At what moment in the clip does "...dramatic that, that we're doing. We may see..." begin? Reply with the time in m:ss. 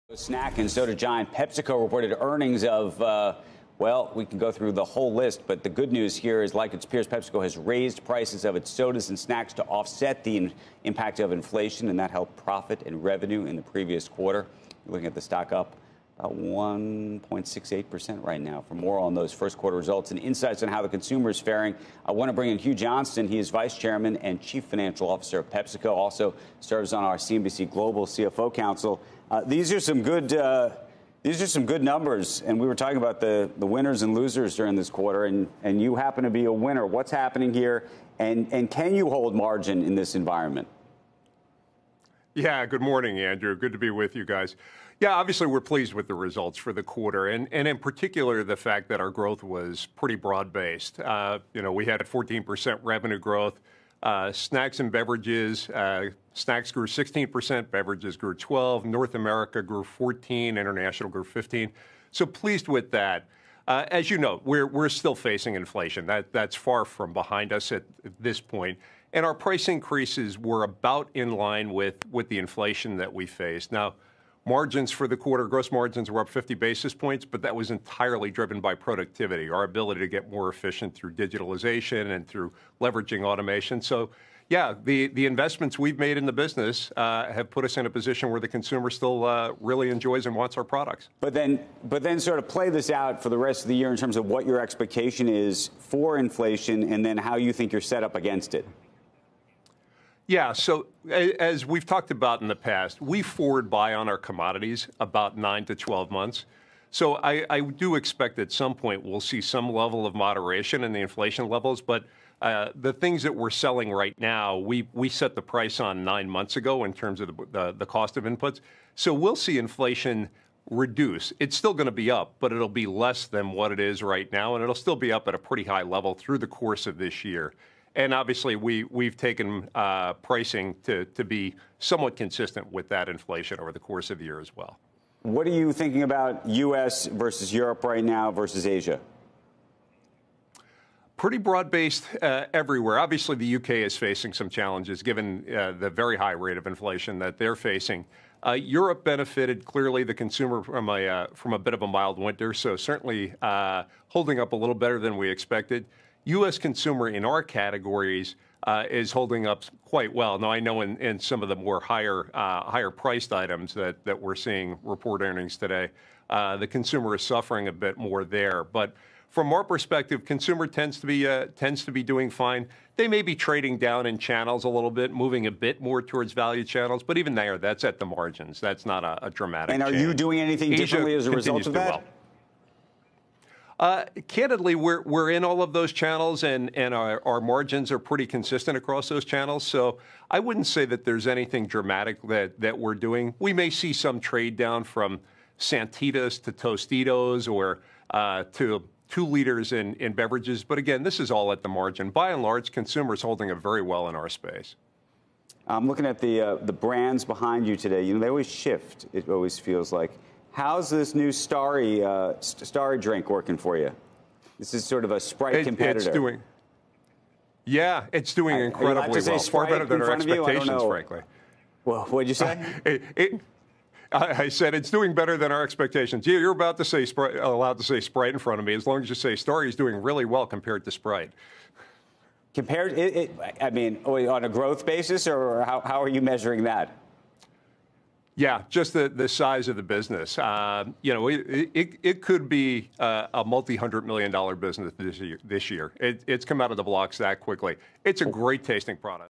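3:11.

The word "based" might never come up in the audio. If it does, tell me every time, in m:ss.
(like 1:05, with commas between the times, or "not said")
0:50, 2:21.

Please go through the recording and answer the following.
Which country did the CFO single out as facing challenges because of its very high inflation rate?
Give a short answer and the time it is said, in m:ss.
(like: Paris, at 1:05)
U.K., at 2:23.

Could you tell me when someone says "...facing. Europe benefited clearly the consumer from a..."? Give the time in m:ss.
2:27.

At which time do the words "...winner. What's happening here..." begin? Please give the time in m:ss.
0:36.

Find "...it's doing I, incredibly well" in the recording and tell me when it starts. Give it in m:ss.
3:38.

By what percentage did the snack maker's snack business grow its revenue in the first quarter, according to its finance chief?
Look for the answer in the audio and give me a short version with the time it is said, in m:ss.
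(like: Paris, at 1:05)
16%, at 0:56.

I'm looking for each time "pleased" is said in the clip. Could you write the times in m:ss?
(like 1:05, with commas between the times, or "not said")
0:45, 1:02.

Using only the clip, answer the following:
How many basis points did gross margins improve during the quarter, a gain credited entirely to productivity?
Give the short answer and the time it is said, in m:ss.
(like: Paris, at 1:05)
50, at 1:16.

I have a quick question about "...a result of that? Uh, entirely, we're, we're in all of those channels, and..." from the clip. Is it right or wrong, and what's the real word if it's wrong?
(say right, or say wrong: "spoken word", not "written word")
wrong: "candidly", not "entirely".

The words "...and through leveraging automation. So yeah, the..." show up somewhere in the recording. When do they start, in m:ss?
1:22.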